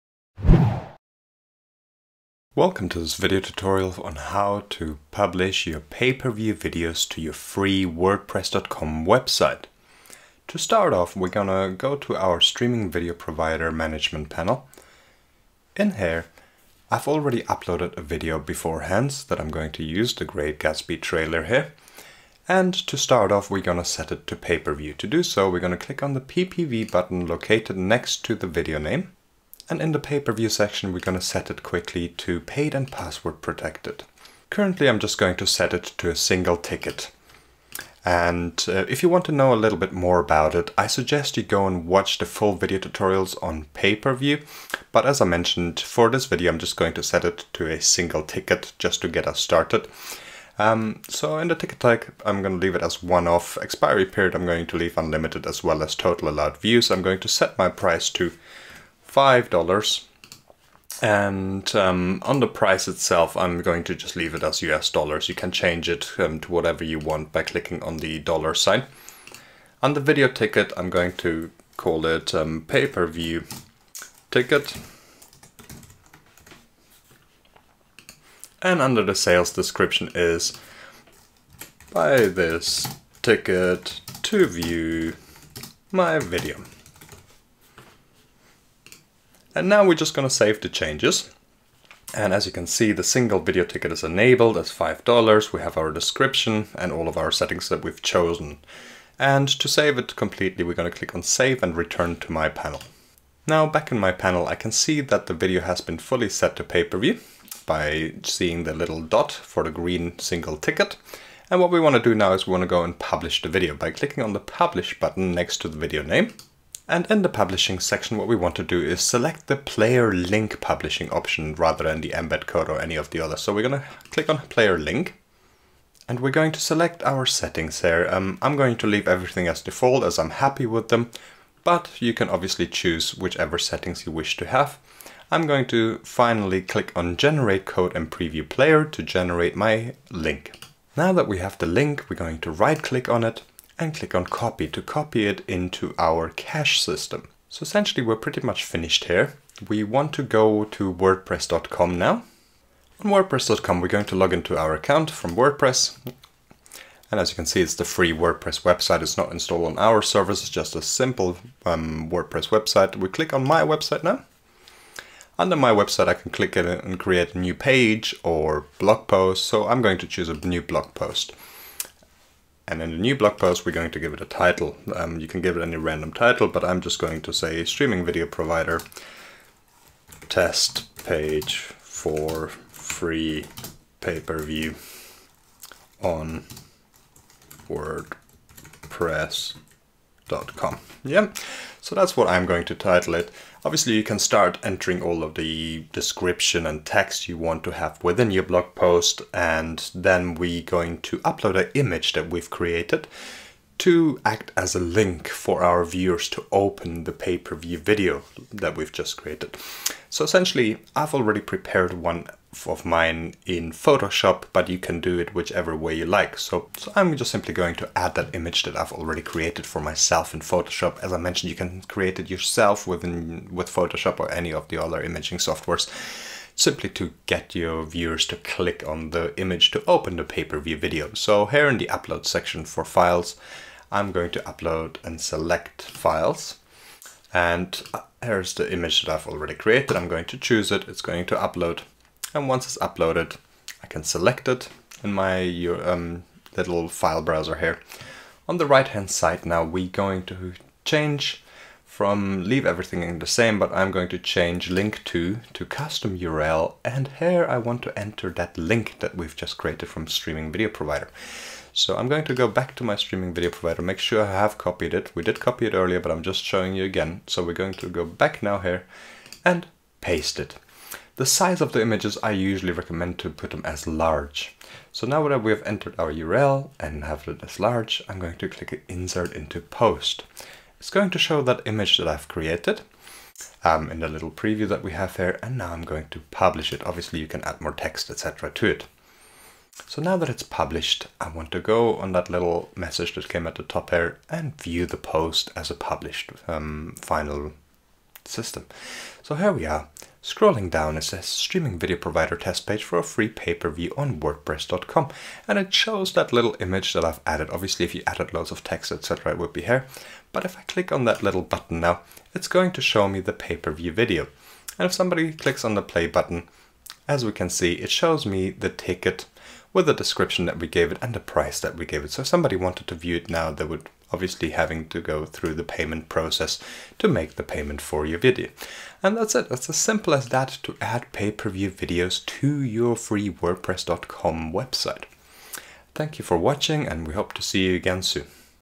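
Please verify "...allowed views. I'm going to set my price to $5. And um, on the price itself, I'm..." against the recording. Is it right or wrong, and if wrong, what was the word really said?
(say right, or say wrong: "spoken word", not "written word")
right.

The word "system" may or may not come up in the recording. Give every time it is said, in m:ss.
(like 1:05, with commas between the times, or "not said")
2:26, 4:58.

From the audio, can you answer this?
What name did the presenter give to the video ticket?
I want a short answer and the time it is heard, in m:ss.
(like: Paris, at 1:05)
pay-per-view ticket, at 1:12.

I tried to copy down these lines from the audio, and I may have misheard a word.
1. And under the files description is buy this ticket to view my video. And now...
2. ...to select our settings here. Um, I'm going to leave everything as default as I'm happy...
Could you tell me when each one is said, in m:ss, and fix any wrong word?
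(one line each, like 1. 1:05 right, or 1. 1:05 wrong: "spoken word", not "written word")
1. 1:18 wrong: "sales", not "files"
2. 2:06 right.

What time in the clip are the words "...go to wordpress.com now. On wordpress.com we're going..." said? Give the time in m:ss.
2:30.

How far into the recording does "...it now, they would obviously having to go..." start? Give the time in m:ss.
5:23.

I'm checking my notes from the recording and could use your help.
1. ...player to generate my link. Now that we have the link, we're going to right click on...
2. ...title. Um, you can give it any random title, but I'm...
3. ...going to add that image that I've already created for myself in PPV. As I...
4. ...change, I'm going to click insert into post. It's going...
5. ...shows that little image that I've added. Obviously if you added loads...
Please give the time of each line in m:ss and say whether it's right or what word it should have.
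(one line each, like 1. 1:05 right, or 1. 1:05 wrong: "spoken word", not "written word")
1. 2:18 right
2. 2:54 right
3. 3:37 wrong: "Photoshop", not "PPV"
4. 4:37 wrong: "large", not "change"
5. 5:05 right.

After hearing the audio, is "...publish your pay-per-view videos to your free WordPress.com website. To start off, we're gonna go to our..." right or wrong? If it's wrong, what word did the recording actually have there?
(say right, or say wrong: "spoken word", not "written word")
right.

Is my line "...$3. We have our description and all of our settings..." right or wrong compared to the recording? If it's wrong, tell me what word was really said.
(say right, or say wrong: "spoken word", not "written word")
wrong: "5", not "3".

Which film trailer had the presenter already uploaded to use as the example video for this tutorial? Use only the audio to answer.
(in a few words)
The Great Gatsby.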